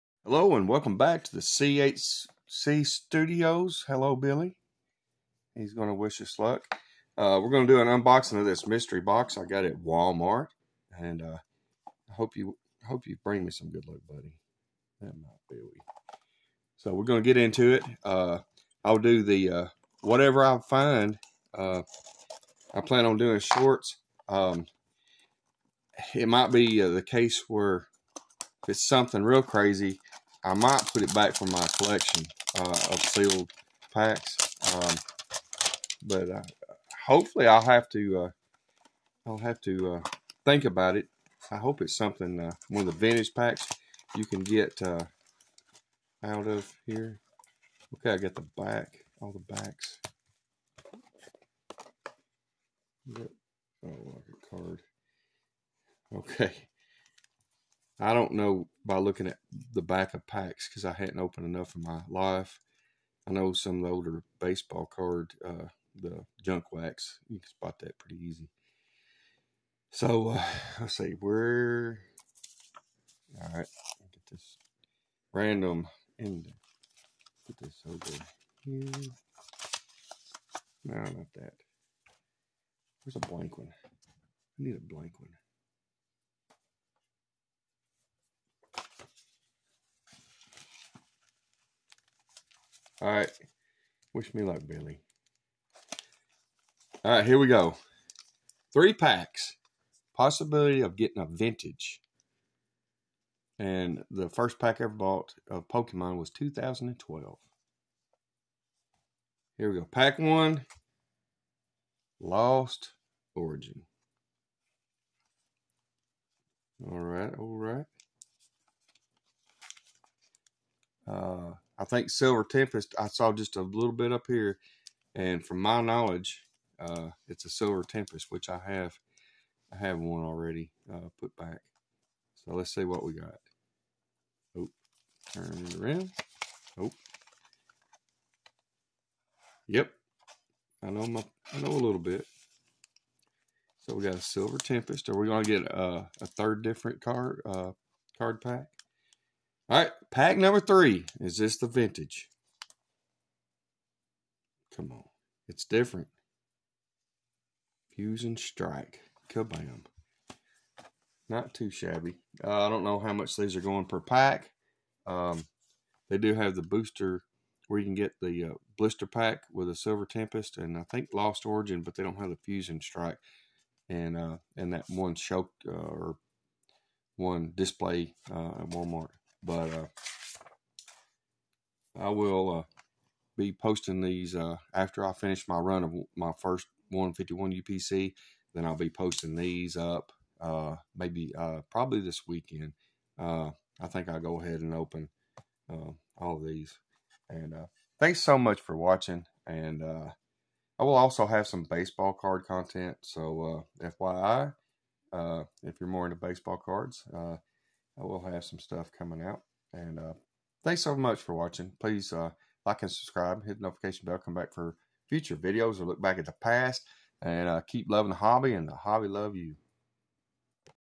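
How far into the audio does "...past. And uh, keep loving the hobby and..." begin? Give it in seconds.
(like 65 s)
216 s.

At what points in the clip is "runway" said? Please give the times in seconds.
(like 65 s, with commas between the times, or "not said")
not said.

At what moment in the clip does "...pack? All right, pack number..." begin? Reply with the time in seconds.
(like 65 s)
148 s.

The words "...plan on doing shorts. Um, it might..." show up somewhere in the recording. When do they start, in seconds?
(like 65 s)
22 s.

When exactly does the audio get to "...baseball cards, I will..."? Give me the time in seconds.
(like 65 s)
206 s.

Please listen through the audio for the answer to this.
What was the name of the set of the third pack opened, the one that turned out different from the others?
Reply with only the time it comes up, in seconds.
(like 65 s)
157 s.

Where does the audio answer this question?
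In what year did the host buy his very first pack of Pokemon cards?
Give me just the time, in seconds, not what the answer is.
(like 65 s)
106 s.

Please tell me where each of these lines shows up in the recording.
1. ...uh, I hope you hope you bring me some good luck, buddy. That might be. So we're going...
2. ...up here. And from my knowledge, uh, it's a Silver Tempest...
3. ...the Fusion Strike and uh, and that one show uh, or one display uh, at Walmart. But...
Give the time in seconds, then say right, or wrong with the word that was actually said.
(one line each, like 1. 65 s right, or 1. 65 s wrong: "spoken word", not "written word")
1. 11 s right
2. 124 s right
3. 172 s right.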